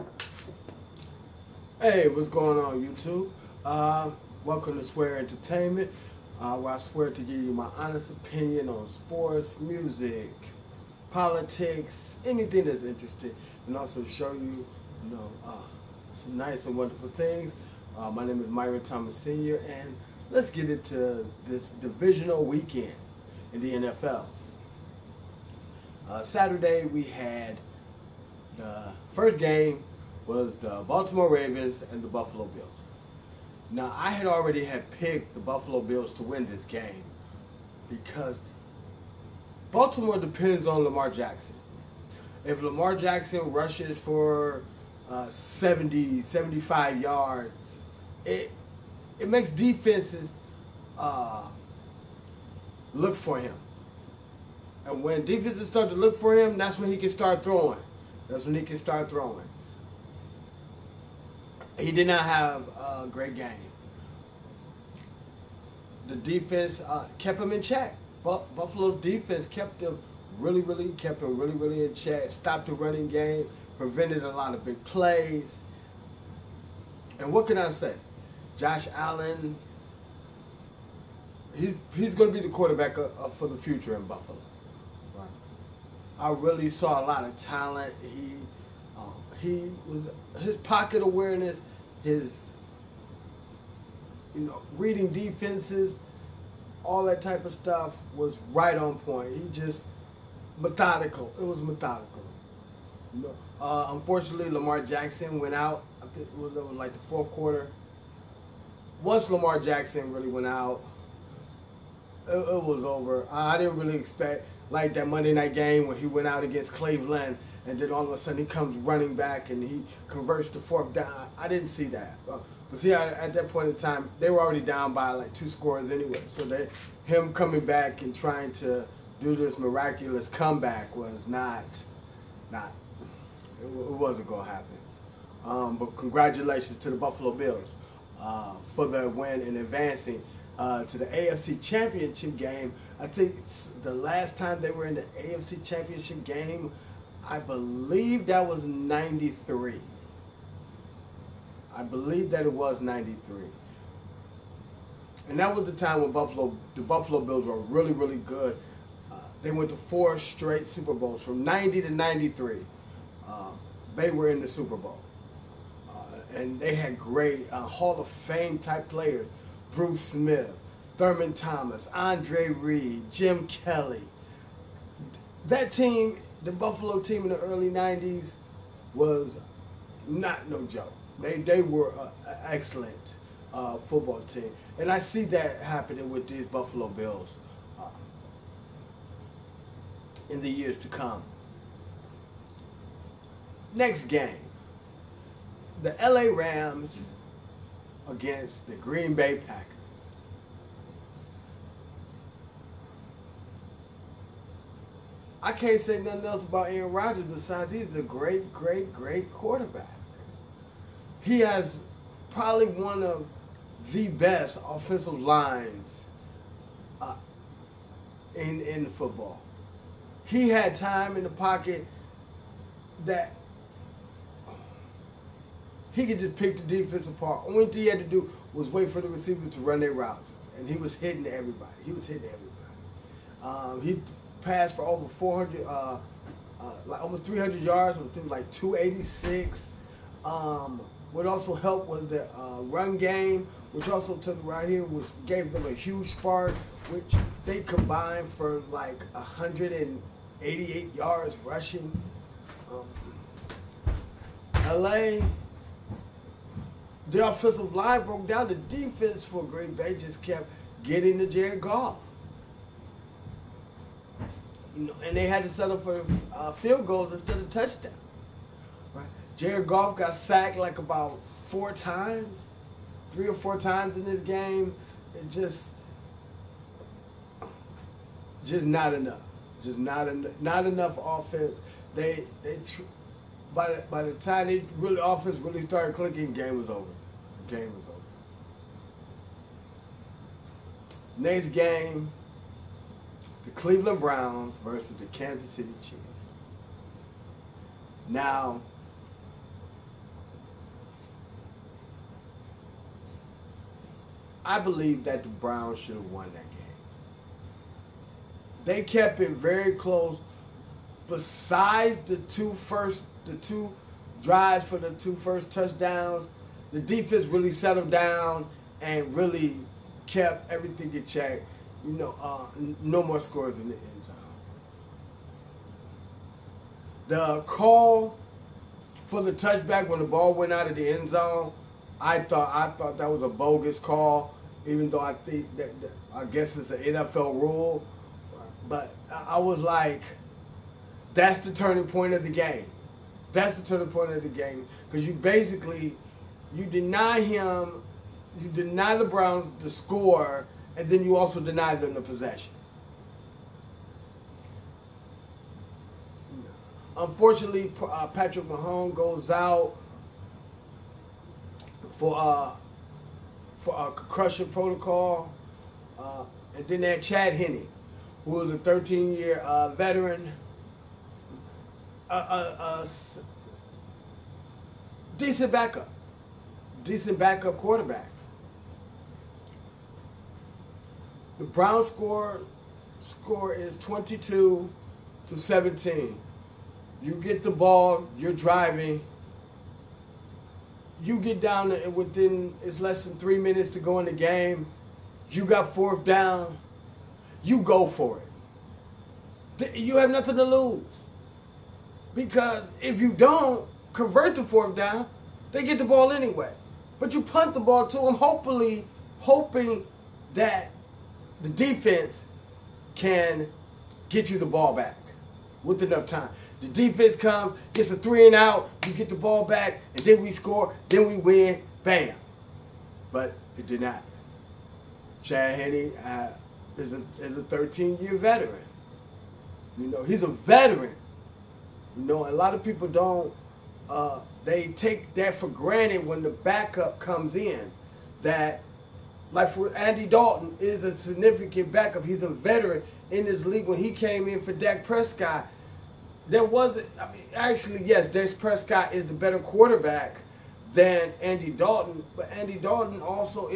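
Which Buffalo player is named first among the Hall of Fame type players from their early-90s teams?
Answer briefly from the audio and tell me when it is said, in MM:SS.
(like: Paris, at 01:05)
Bruce Smith, at 02:49.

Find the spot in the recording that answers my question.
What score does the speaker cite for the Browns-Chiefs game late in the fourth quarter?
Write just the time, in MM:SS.
06:23.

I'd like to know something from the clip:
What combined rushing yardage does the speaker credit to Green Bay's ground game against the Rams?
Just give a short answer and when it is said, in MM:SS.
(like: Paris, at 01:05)
188, at 04:09.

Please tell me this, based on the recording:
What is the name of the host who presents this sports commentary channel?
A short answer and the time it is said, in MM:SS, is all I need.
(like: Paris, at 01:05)
Myron Thomas Sr., at 00:18.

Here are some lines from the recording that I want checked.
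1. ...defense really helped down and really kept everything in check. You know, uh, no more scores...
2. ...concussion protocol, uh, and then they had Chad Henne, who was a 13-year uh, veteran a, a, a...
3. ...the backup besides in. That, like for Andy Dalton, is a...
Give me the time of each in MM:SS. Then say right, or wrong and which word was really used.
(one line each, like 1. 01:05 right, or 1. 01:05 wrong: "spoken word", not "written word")
1. 05:16 wrong: "settled", not "helped"
2. 06:03 right
3. 07:16 wrong: "comes", not "besides".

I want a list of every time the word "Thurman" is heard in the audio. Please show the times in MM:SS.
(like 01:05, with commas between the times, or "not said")
02:50.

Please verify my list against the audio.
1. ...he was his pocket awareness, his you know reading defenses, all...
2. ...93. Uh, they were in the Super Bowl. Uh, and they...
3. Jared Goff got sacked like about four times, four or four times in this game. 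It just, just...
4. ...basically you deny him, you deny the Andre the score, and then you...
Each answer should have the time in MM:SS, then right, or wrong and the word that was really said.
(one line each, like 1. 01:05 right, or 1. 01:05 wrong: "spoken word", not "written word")
1. 01:29 right
2. 02:41 right
3. 04:29 wrong: "three", not "four"
4. 05:45 wrong: "Browns", not "Andre".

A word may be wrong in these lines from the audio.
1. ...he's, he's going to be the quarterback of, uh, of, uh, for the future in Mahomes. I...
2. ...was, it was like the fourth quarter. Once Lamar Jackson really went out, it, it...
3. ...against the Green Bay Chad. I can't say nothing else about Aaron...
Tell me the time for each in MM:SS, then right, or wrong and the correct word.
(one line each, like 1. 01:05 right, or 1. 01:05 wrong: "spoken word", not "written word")
1. 01:21 wrong: "Buffalo", not "Mahomes"
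2. 01:46 right
3. 03:18 wrong: "Packers", not "Chad".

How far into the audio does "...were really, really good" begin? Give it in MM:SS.
02:37.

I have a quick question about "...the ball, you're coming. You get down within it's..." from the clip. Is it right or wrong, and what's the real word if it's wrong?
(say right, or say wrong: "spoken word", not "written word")
wrong: "driving", not "coming".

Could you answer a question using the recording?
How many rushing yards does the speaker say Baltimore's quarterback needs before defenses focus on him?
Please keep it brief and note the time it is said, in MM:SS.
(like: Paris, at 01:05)
70, 75, at 00:45.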